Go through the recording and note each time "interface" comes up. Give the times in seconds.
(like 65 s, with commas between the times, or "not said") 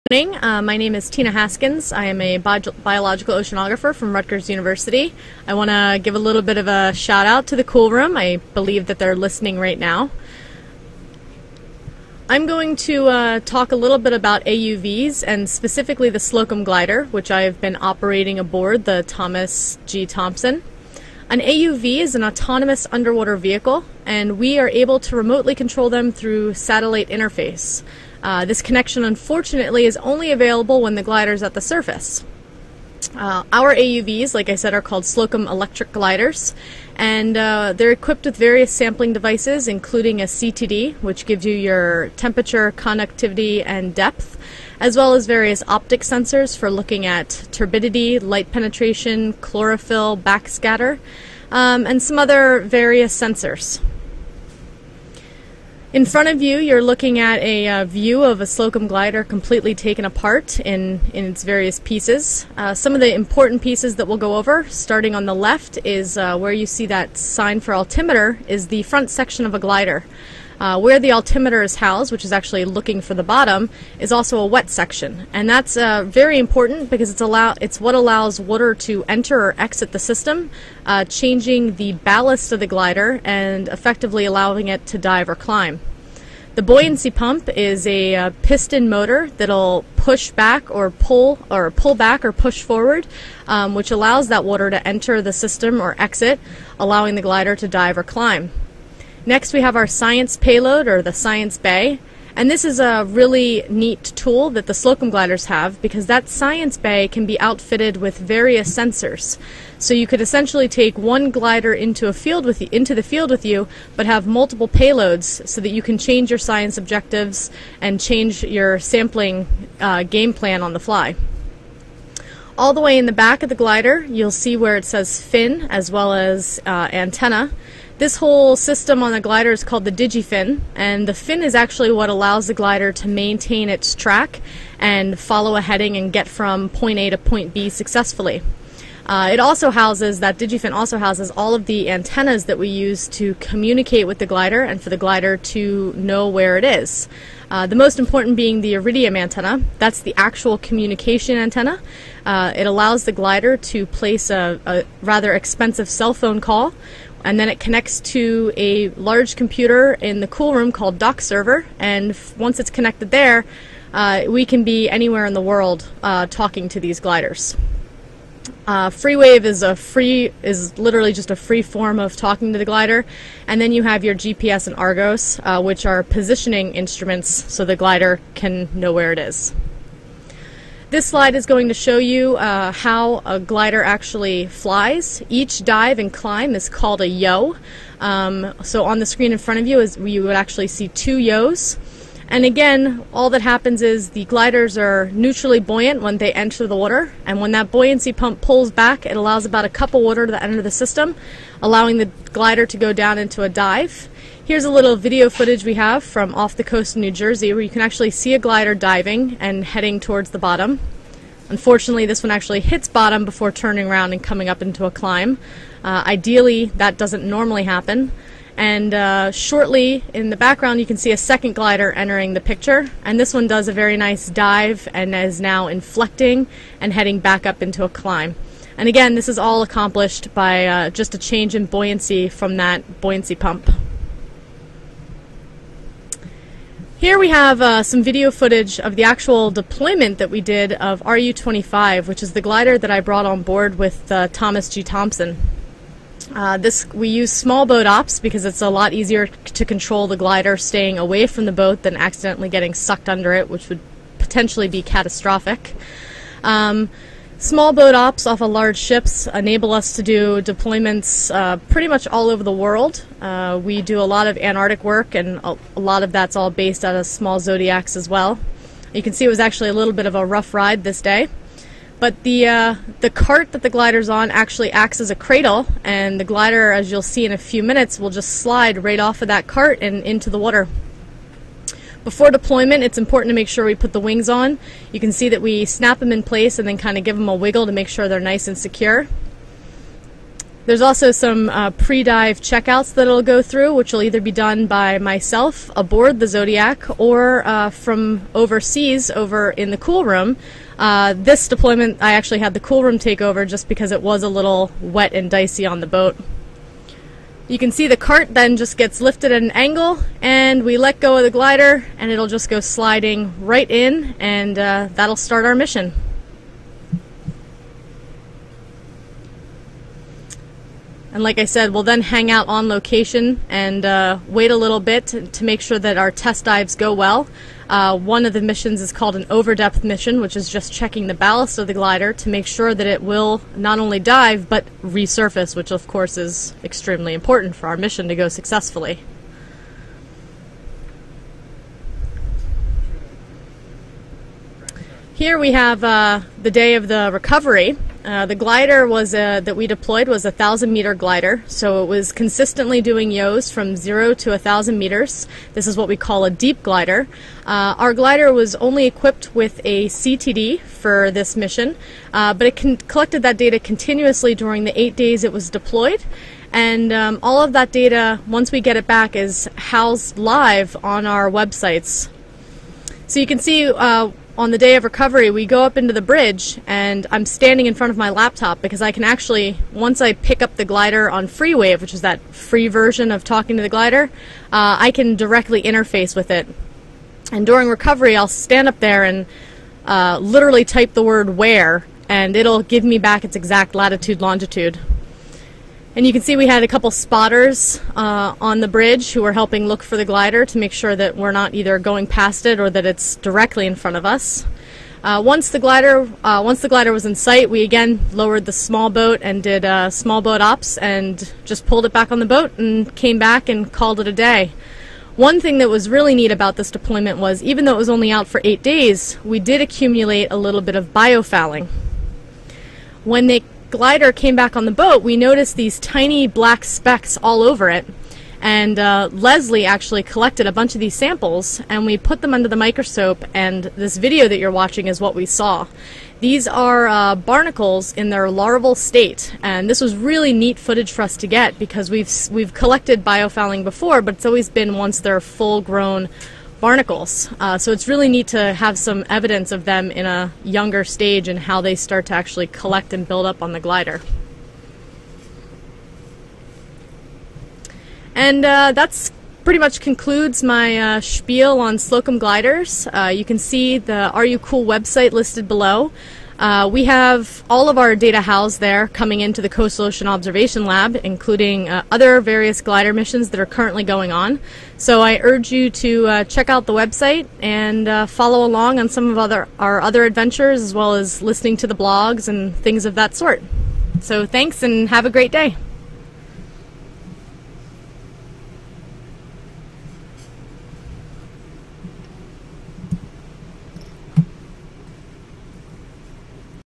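27 s, 385 s.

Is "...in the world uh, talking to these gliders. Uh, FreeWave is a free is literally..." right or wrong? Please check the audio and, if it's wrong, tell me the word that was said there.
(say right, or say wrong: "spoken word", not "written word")
right.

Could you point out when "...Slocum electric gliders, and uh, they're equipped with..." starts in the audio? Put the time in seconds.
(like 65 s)
35 s.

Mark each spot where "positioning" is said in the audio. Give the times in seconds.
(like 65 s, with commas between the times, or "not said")
176 s.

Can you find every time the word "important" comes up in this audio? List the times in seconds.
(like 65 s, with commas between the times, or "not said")
63 s, 76 s, 147 s, 282 s, 337 s.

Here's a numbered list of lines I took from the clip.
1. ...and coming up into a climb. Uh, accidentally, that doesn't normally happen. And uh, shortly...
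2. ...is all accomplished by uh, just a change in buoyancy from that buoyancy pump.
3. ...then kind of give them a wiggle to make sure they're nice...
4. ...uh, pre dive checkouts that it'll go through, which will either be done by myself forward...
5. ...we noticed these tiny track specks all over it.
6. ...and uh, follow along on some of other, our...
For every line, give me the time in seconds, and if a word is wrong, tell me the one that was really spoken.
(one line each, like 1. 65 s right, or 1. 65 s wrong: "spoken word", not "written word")
1. 214 s wrong: "ideally", not "accidentally"
2. 229 s right
3. 286 s right
4. 291 s wrong: "aboard", not "forward"
5. 425 s wrong: "black", not "track"
6. 477 s right.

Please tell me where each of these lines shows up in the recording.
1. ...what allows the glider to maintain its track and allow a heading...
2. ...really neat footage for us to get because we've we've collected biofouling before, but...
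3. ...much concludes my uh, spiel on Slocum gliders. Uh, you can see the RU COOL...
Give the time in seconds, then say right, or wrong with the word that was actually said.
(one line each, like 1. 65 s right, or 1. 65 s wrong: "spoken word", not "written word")
1. 131 s wrong: "follow", not "allow"
2. 439 s right
3. 459 s right.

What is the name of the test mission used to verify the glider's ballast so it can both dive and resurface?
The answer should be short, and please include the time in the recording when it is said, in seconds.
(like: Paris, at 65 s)
overdepth mission, at 329 s.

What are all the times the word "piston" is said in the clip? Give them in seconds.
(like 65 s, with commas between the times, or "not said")
88 s.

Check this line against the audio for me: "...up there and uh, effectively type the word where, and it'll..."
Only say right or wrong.
wrong.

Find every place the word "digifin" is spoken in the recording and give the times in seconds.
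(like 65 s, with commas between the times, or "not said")
129 s, 140 s.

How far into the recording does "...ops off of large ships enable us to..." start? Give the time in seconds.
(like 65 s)
257 s.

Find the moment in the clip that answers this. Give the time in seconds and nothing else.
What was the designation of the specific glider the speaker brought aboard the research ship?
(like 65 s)
241 s.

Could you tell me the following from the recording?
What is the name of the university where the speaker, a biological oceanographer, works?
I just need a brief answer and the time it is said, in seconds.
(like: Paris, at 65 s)
Rutgers University, at 4 s.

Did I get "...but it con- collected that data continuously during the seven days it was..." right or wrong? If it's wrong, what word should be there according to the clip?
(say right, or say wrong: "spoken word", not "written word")
wrong: "eight", not "seven".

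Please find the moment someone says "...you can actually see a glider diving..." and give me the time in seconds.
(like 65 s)
207 s.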